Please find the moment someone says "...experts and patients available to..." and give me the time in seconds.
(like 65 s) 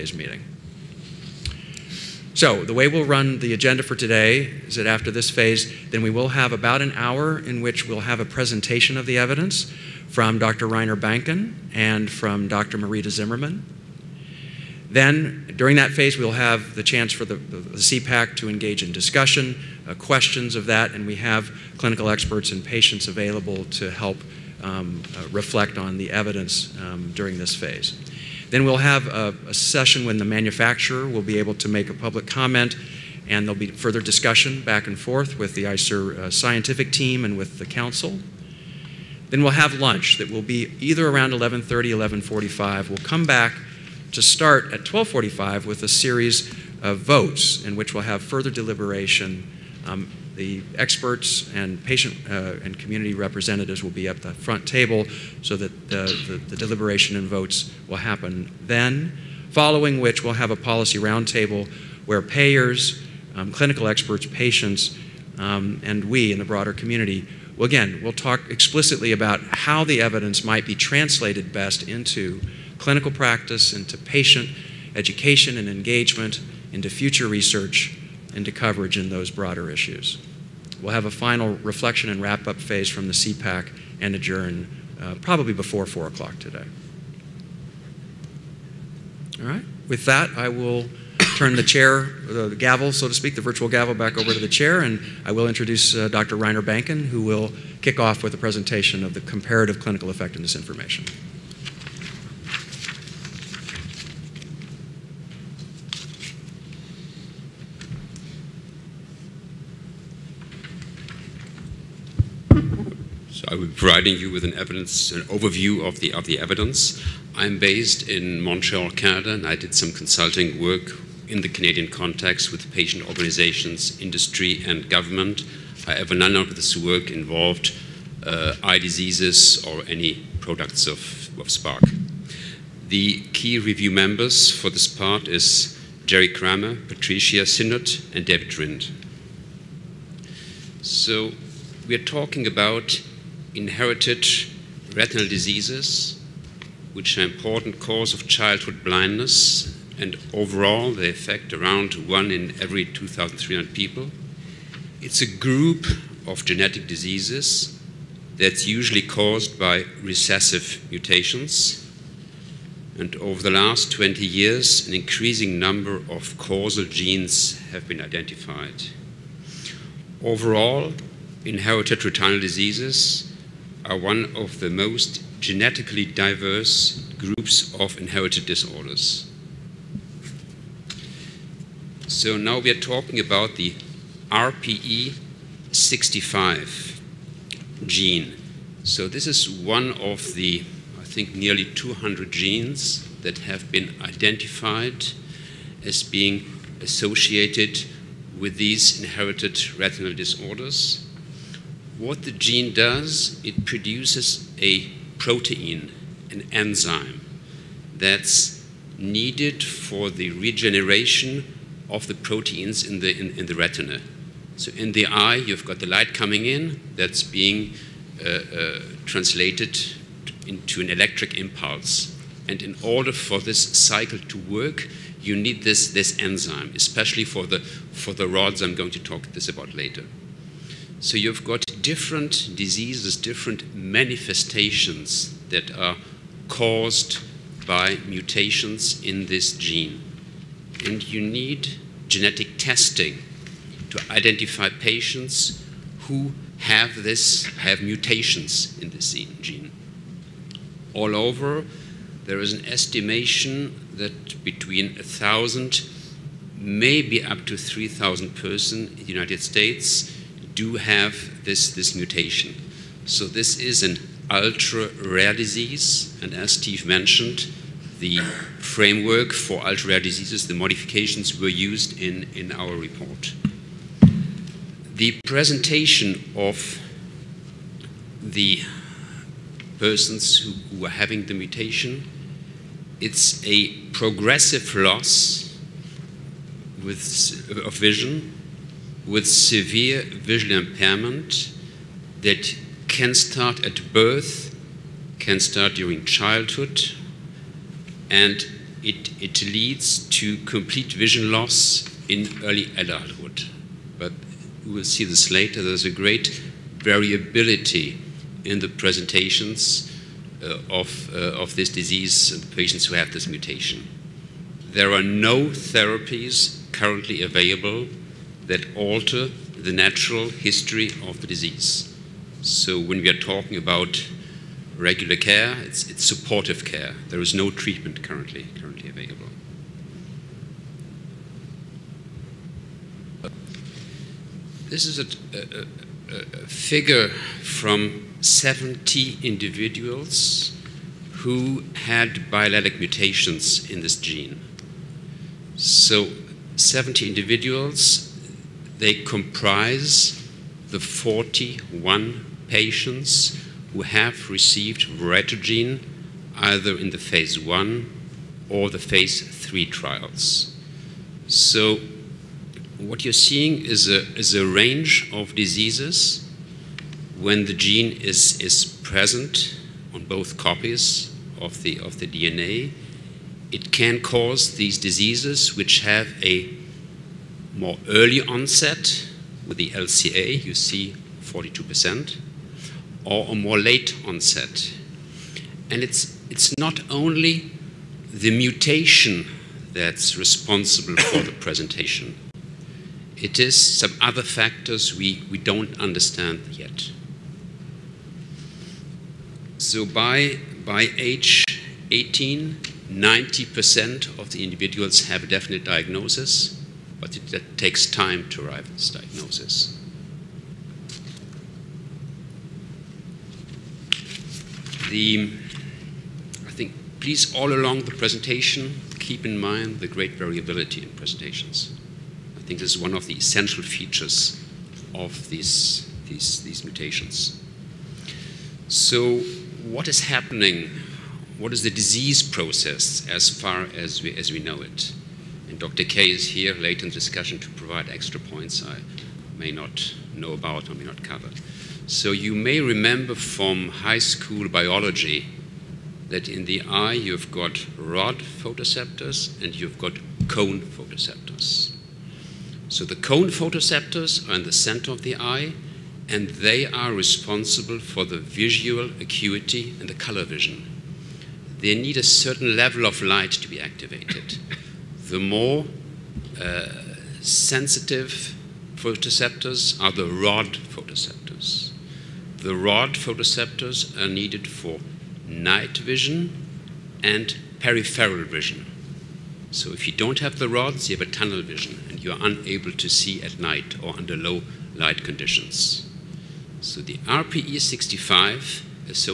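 22 s.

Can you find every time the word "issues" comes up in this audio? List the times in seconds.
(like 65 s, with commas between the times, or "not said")
79 s.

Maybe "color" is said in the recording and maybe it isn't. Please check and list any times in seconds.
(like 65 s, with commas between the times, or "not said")
459 s.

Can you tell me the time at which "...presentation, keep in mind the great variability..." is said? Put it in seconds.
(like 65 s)
417 s.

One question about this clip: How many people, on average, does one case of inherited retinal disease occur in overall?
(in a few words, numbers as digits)
2,300.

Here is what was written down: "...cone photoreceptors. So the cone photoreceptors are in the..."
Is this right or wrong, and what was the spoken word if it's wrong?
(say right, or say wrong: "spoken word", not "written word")
right.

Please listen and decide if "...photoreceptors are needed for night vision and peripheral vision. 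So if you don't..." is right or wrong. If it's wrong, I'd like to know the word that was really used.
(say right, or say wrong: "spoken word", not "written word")
right.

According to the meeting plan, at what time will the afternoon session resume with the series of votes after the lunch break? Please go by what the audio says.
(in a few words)
12:45.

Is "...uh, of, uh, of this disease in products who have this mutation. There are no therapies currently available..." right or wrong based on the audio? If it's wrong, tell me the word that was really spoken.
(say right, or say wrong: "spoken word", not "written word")
wrong: "patients", not "products".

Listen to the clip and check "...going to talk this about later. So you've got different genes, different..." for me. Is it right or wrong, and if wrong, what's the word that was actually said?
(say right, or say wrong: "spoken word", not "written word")
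wrong: "diseases", not "genes".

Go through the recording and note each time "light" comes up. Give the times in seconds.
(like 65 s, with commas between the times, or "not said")
215 s, 463 s, 484 s.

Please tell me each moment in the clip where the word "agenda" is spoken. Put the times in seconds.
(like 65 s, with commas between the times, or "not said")
3 s.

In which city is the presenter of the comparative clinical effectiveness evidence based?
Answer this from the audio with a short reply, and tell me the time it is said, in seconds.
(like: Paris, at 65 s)
Montreal, at 118 s.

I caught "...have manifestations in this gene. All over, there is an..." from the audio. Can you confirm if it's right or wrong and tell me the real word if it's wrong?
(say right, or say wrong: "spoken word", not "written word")
wrong: "mutations", not "manifestations".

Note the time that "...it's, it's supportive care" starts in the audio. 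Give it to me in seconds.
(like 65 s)
325 s.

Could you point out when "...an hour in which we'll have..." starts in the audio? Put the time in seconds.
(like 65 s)
6 s.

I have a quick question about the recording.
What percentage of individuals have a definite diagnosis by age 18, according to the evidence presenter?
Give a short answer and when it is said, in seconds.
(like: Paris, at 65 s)
90%, at 402 s.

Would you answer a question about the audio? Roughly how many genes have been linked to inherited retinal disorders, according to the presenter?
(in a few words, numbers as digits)
nearly 200.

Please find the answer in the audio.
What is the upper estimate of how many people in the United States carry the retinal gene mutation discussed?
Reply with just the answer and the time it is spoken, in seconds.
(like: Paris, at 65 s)
3,000, at 257 s.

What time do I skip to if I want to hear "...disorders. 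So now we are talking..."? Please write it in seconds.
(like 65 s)
178 s.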